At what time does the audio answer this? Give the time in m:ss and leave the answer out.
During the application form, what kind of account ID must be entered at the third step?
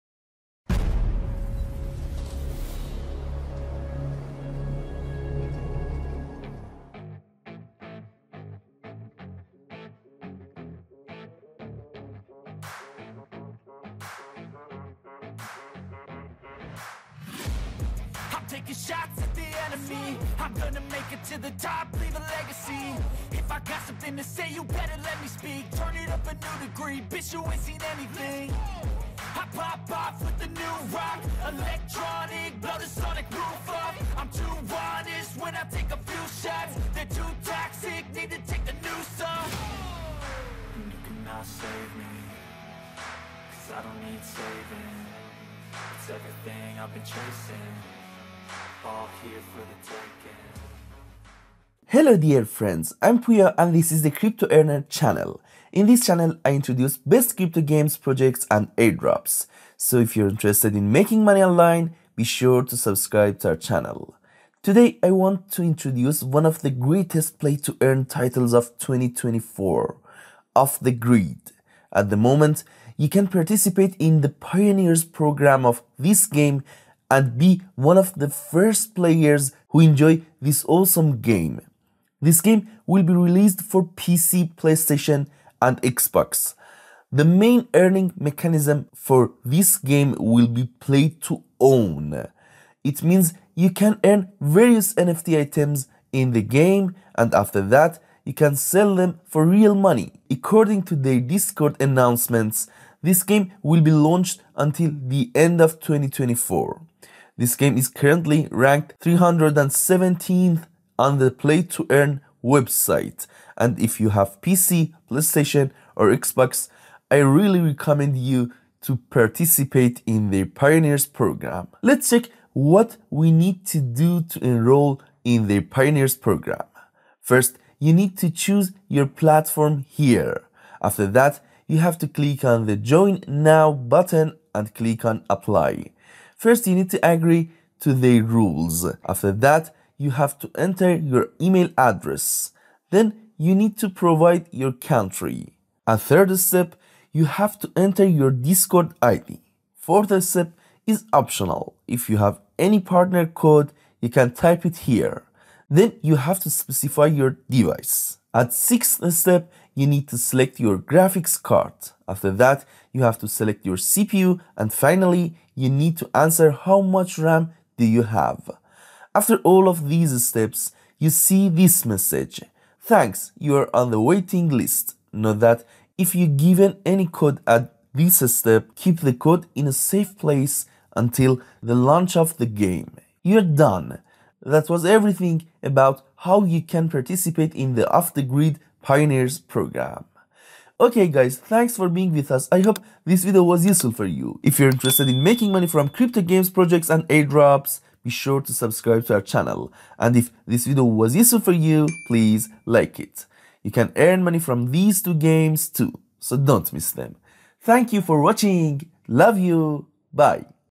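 2:28.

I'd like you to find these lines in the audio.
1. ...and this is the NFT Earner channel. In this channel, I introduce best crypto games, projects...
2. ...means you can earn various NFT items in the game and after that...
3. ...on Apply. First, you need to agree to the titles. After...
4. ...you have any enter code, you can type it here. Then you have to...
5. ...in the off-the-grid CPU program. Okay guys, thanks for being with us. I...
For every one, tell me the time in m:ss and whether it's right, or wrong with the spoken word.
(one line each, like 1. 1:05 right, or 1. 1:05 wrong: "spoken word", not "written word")
1. 0:53 wrong: "Crypto", not "NFT"
2. 1:33 right
3. 2:15 wrong: "rules", not "titles"
4. 2:32 wrong: "partner", not "enter"
5. 3:07 wrong: "Pioneers", not "CPU".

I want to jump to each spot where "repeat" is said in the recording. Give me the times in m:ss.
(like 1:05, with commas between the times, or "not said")
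not said.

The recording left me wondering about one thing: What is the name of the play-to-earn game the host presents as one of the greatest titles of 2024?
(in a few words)
Off the Grid.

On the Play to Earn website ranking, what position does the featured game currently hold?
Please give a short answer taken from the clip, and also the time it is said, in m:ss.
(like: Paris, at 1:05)
317th, at 1:48.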